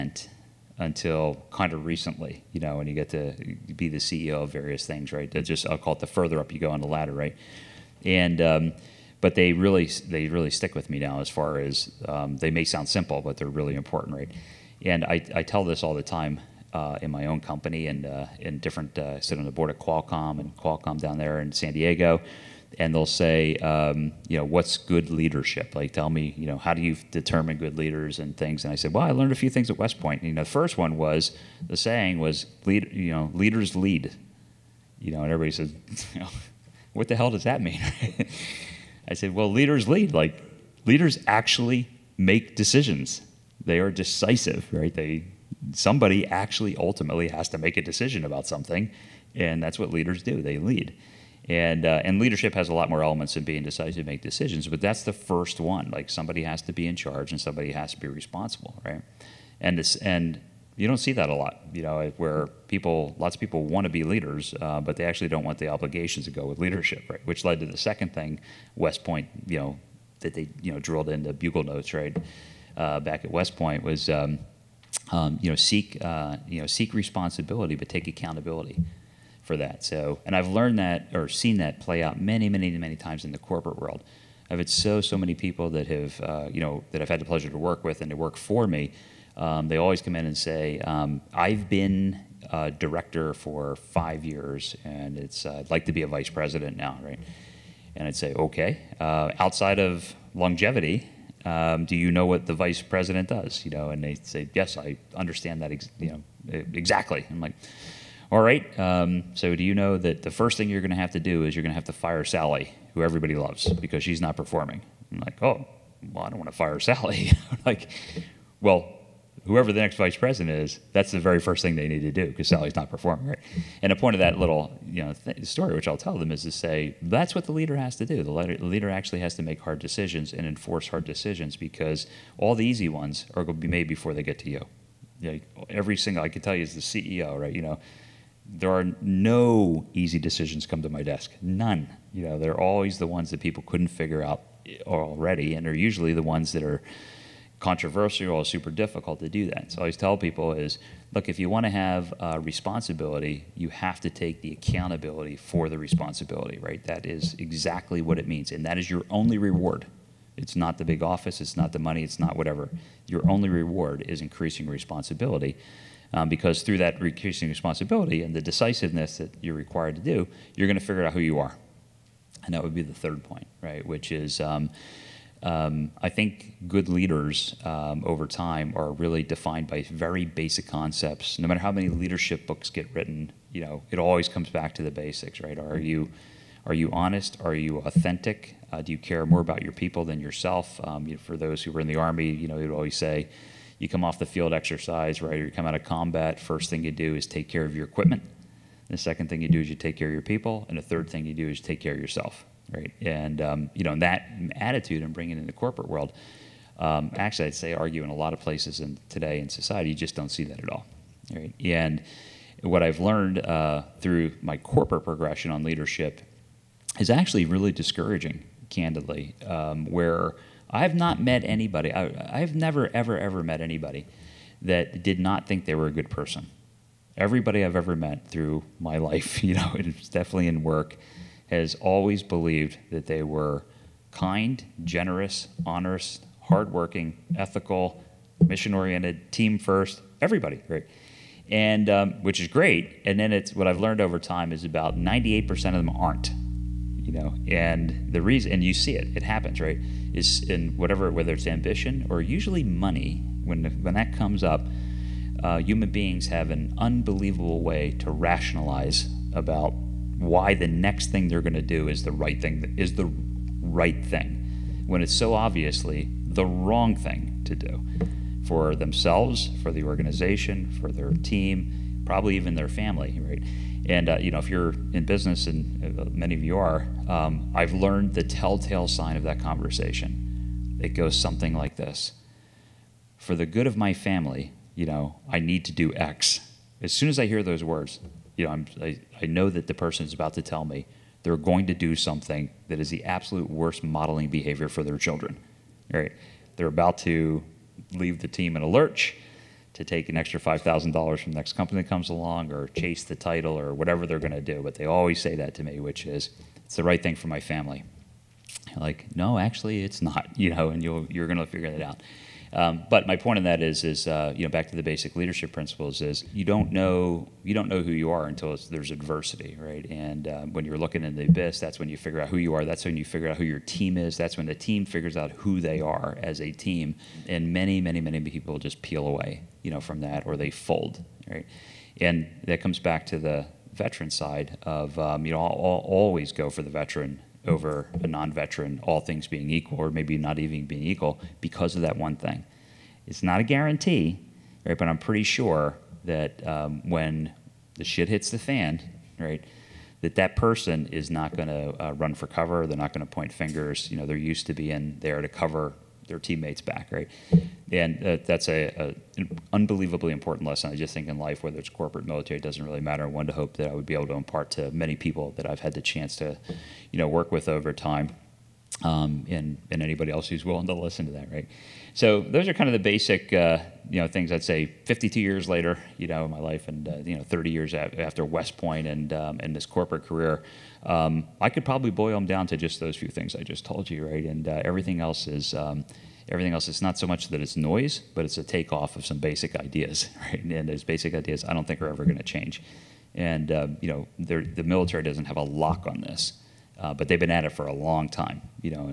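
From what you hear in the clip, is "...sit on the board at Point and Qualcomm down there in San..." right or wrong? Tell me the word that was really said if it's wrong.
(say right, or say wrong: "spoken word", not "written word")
wrong: "Qualcomm", not "Point".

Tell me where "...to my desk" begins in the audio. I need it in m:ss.
2:20.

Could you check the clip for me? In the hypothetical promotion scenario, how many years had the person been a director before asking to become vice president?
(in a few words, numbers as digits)
5.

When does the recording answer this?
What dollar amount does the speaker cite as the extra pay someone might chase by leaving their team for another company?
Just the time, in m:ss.
5:00.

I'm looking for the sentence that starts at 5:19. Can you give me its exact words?
And um, when you're looking in the abyss, that's when you figure out who you are.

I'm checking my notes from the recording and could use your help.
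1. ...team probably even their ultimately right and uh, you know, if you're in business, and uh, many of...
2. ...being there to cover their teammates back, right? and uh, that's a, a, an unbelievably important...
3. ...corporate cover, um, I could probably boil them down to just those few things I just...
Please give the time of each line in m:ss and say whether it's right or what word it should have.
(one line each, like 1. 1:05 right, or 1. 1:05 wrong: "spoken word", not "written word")
1. 4:31 wrong: "family", not "ultimately"
2. 5:54 right
3. 6:19 wrong: "career", not "cover".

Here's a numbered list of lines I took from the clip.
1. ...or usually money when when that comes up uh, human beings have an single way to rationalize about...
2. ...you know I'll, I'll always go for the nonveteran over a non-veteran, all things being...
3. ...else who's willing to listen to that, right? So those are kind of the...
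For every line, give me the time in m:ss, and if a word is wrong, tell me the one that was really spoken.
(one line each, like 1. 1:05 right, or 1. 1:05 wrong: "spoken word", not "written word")
1. 4:12 wrong: "unbelievable", not "single"
2. 5:35 wrong: "veteran", not "nonveteran"
3. 6:10 right.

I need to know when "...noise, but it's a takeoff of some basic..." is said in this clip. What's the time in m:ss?
6:27.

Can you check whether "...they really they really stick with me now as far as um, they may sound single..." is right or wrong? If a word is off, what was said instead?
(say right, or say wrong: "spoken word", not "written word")
wrong: "simple", not "single".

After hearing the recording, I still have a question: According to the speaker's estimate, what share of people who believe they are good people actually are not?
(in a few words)
98%.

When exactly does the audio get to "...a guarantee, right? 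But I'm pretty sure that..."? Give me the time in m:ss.
5:43.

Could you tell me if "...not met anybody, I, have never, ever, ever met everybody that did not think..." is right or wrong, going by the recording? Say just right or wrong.
wrong.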